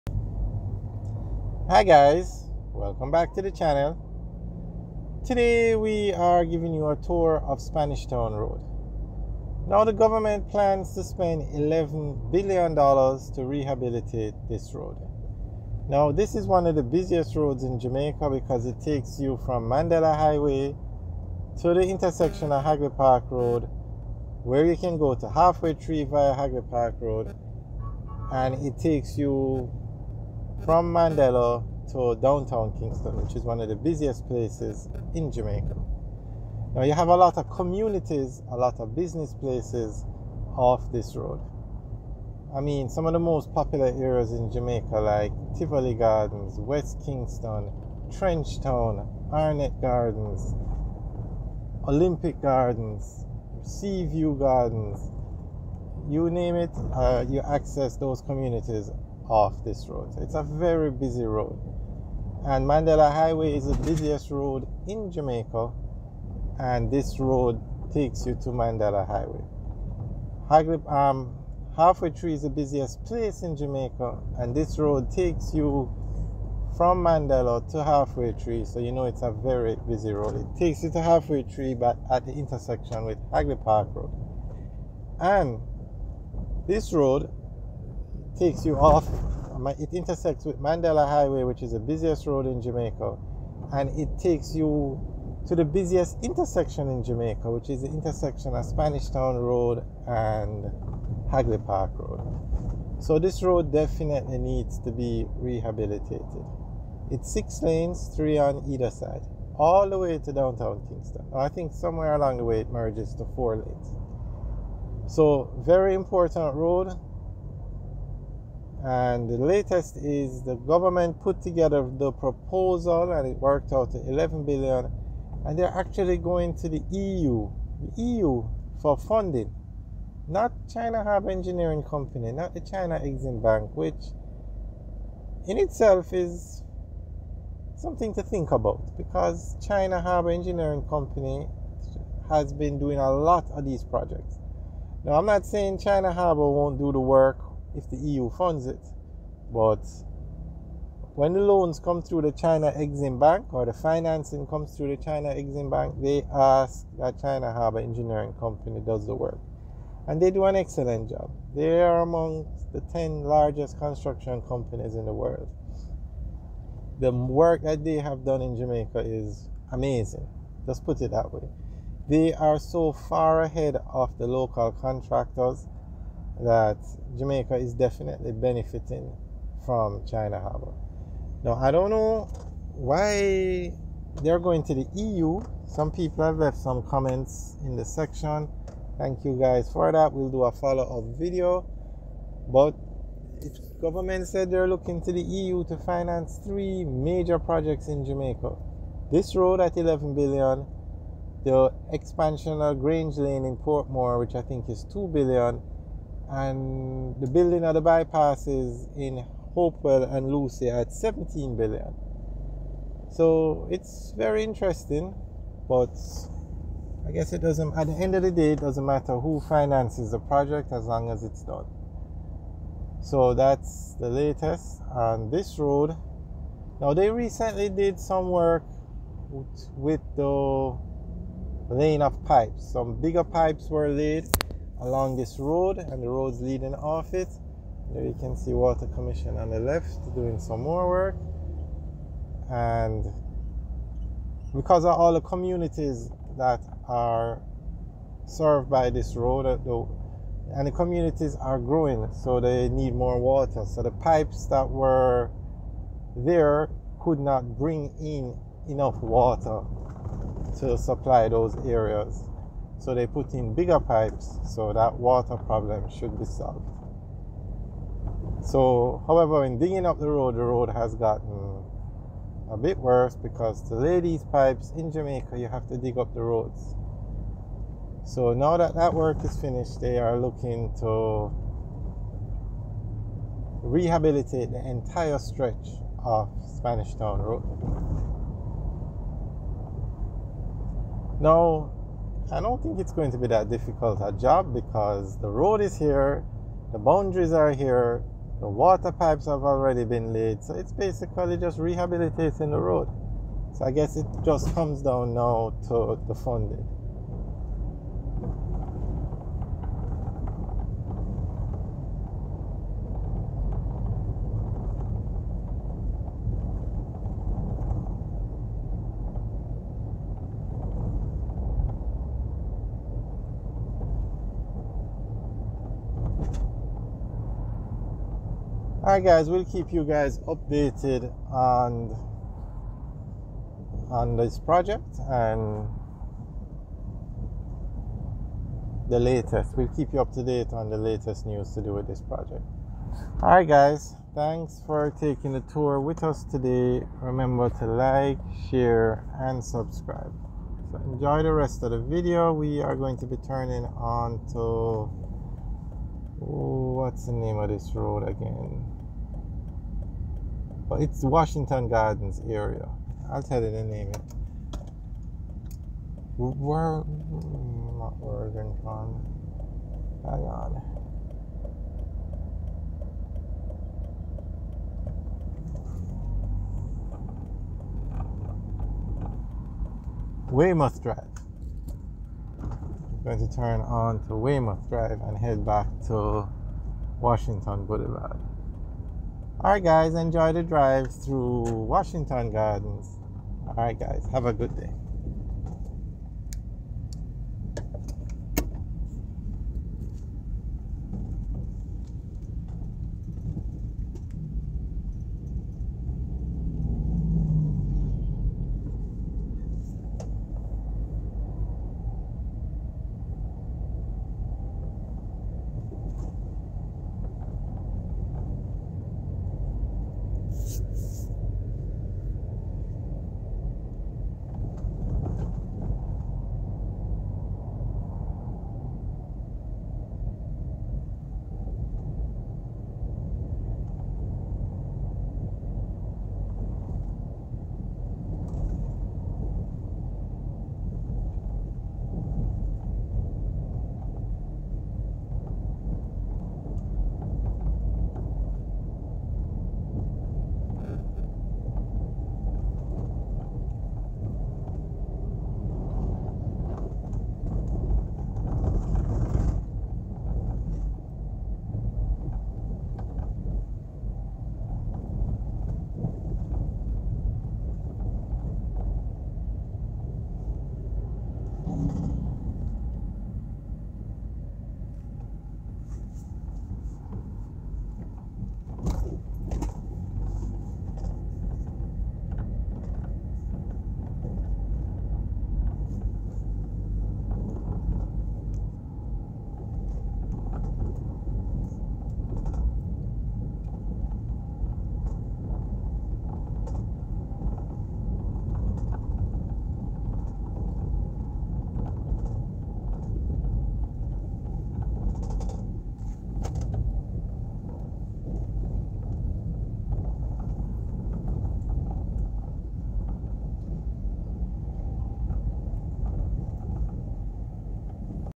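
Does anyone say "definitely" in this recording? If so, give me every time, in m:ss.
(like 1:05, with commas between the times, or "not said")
1:43, 2:57.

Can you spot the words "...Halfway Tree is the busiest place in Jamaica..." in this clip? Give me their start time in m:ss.
1:11.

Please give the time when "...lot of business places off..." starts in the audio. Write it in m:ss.
0:38.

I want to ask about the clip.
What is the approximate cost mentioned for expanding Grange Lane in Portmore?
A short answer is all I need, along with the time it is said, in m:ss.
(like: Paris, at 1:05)
2 billion, at 3:24.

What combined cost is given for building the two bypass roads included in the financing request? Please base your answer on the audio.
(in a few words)
17 billion.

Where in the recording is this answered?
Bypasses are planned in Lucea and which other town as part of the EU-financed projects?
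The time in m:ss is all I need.
3:29.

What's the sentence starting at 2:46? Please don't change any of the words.
The work that they have done in Jamaica is amazing.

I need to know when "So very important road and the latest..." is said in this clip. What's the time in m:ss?
1:55.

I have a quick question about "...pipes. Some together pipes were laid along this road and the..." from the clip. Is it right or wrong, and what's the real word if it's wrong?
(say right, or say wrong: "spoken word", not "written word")
wrong: "bigger", not "together".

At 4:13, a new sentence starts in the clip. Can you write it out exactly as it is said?
So the pipes that were there could not bring in enough water to supply those areas.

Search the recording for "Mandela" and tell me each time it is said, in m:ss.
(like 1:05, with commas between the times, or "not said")
0:19, 0:30, 1:02, 1:08, 1:17, 1:30.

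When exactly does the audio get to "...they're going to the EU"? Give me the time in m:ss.
3:04.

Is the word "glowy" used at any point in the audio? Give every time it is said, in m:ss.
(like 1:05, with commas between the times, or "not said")
not said.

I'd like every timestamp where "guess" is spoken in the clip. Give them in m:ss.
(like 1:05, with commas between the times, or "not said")
3:37, 5:03.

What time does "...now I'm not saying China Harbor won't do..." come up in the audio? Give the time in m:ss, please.
2:25.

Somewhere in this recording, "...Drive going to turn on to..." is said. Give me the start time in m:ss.
6:20.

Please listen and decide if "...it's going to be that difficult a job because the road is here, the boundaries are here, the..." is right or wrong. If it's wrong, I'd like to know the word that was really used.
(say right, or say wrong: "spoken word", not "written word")
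right.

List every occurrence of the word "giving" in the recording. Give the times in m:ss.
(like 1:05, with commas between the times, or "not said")
0:06.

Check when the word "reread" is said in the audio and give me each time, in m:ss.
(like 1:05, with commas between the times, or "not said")
not said.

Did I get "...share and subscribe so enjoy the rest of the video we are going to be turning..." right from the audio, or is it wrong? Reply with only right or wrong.
right.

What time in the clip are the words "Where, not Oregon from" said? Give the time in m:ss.
6:06.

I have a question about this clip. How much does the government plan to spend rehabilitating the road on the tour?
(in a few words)
11 billion dollars.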